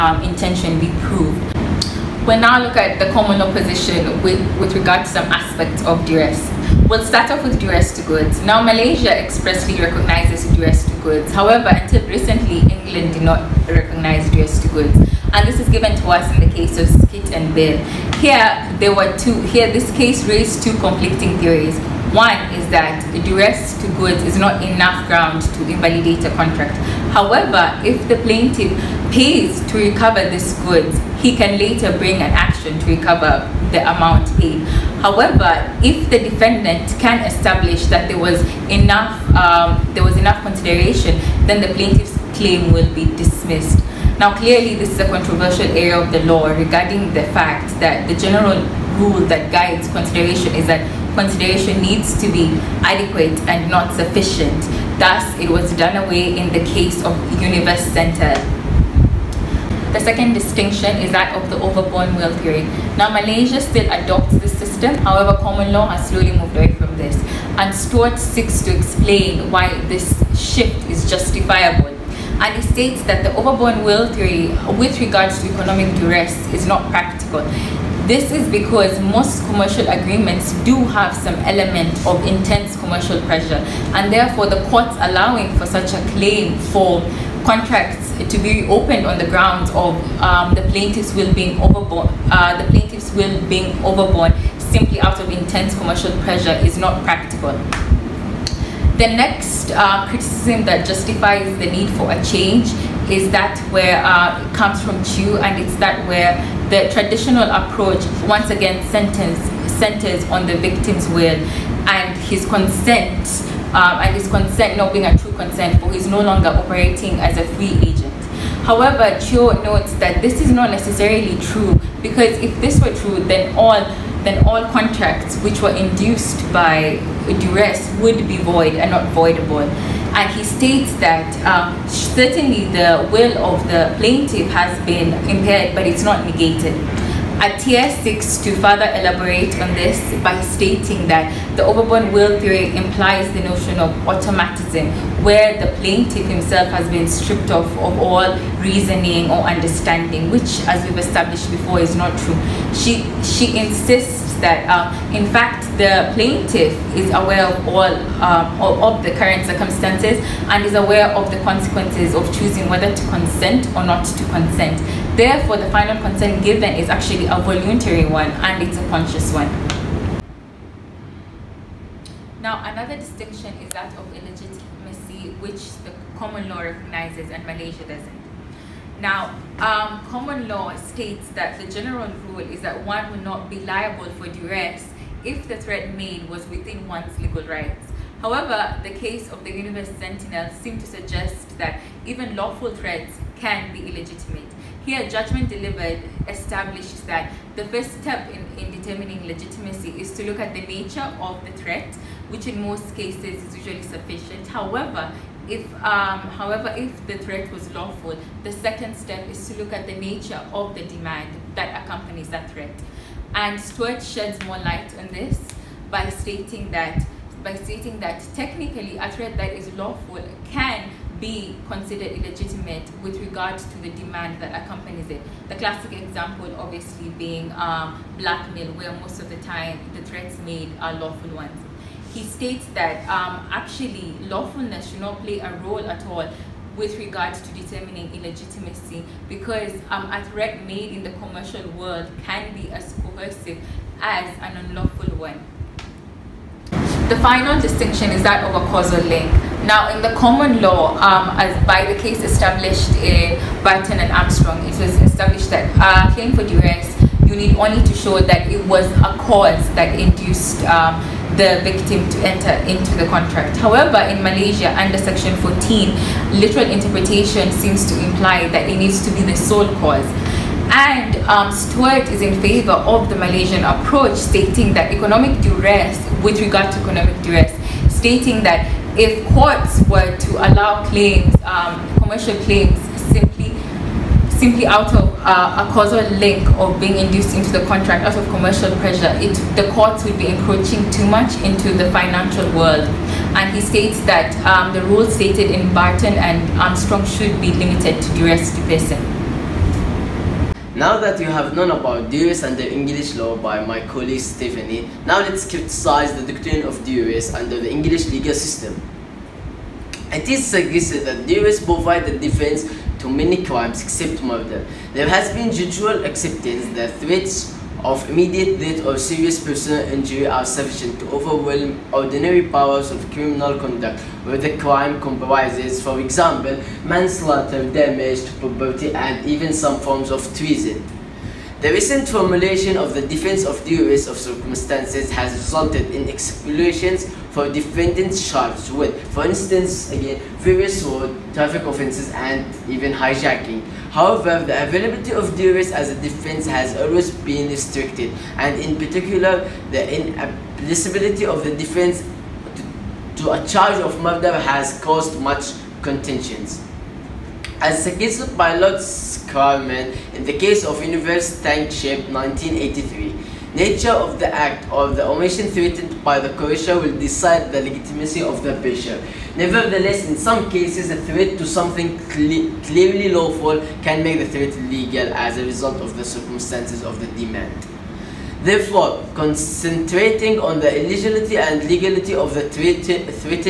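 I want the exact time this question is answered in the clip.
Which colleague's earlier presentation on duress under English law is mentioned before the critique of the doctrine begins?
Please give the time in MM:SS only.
05:04.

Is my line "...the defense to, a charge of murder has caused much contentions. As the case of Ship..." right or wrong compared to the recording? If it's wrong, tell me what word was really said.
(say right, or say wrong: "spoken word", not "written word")
wrong: "Pilot", not "Ship".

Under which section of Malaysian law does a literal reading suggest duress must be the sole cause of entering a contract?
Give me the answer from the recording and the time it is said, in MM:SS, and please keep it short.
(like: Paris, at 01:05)
Section 14, at 04:24.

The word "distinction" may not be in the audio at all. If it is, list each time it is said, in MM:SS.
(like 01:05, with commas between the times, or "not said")
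01:00, 02:52, 04:07.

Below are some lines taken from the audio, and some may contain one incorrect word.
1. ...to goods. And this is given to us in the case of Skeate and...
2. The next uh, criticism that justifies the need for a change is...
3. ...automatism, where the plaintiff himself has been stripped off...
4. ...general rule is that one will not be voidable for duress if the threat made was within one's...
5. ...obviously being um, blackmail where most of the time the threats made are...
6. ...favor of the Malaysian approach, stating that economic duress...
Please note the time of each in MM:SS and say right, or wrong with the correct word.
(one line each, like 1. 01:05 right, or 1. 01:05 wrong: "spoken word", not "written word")
1. 00:14 right
2. 01:39 right
3. 02:24 right
4. 03:01 wrong: "liable", not "voidable"
5. 03:46 right
6. 04:32 right.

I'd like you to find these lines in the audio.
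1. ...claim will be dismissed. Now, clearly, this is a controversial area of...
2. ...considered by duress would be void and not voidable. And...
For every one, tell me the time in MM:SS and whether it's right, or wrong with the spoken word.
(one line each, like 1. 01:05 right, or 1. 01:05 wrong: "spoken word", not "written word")
1. 00:42 right
2. 02:05 wrong: "induced", not "considered".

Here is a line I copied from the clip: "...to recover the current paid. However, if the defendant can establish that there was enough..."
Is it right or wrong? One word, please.
wrong.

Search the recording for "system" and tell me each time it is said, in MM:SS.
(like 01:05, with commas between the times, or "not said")
01:04, 05:08.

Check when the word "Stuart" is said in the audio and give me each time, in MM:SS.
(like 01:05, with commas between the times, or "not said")
01:07, 03:33.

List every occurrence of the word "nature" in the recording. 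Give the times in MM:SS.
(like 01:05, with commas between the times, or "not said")
03:20, 03:29, 06:03.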